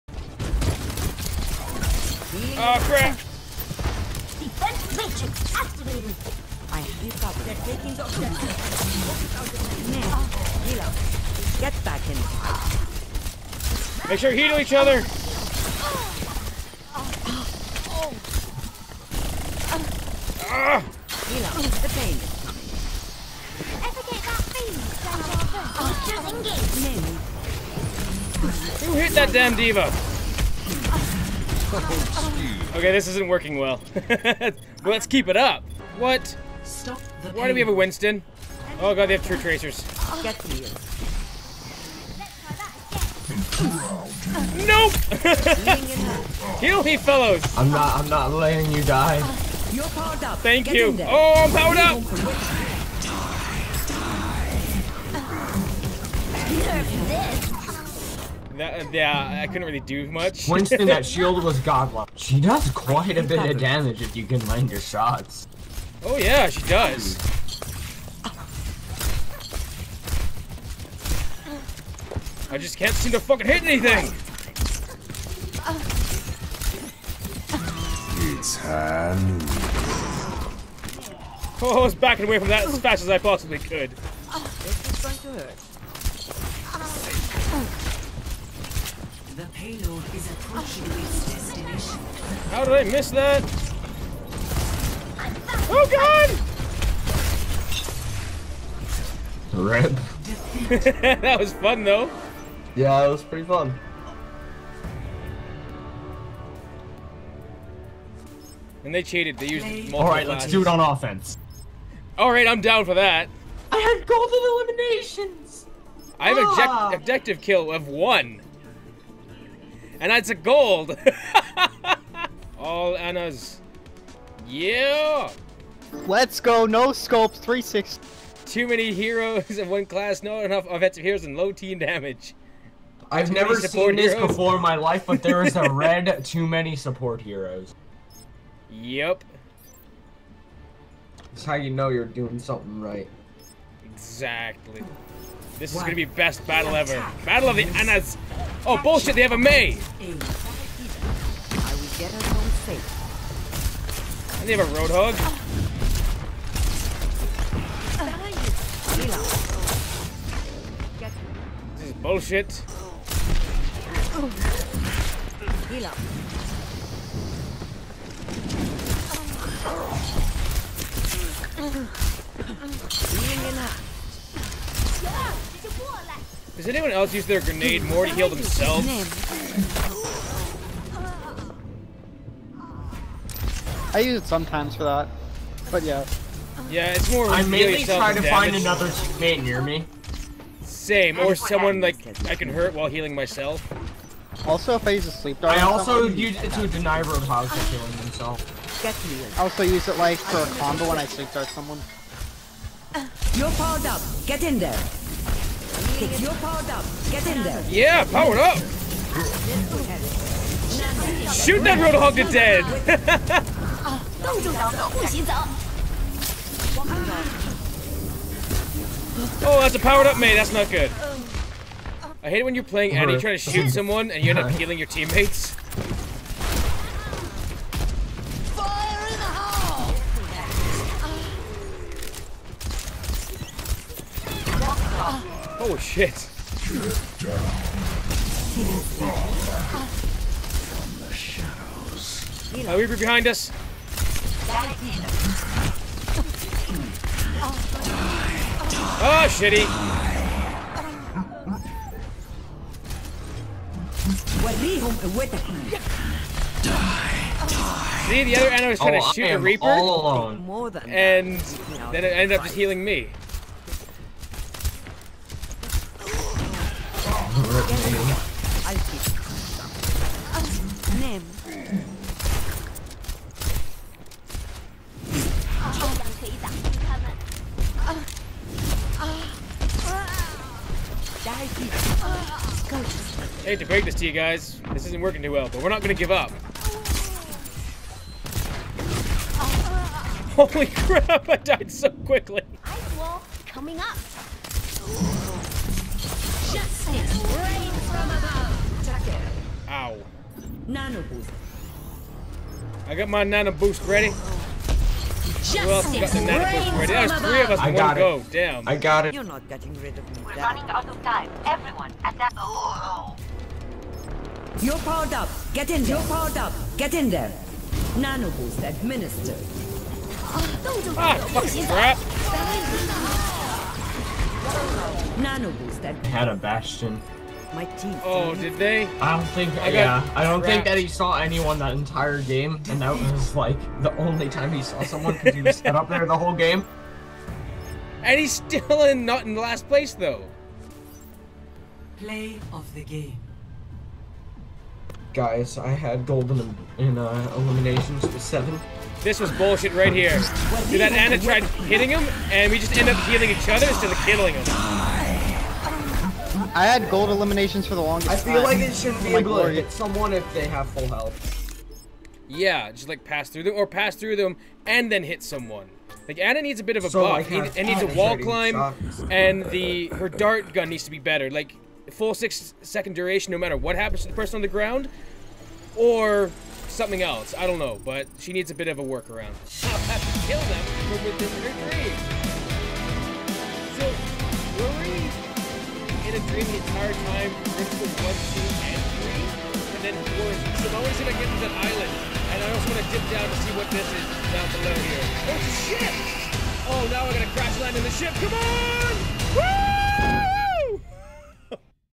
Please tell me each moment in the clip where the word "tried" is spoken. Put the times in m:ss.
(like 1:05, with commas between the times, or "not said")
5:51.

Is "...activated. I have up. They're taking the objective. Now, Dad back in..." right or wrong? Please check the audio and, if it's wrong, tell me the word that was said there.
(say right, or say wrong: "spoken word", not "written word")
wrong: "Get", not "Dad".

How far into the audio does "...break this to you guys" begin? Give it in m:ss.
4:43.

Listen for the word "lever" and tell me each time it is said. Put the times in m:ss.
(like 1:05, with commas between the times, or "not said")
not said.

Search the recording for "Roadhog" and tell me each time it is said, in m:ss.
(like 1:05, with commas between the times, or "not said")
2:34, 3:17, 3:31.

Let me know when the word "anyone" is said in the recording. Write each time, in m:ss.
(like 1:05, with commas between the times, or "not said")
2:56, 5:31.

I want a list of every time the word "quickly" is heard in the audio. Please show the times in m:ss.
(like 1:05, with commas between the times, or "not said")
4:51.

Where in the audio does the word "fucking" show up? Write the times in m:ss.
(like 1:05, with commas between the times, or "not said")
1:13, 5:21.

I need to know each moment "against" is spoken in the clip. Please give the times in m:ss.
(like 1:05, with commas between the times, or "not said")
not said.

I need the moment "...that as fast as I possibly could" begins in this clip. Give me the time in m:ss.
1:22.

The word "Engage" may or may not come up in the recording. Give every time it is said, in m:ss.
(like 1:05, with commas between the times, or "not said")
0:26.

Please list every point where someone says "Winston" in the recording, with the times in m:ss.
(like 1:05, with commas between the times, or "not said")
0:37, 1:00.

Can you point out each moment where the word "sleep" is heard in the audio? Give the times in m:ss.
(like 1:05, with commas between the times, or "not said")
3:15, 3:21.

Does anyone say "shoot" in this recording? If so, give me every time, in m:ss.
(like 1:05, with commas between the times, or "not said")
3:31, 3:43, 4:19.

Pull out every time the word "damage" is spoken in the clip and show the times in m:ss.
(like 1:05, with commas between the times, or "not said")
1:03, 2:11.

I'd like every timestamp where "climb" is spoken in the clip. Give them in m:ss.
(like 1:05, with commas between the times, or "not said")
6:08.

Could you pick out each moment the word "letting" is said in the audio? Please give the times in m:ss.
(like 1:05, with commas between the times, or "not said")
0:48.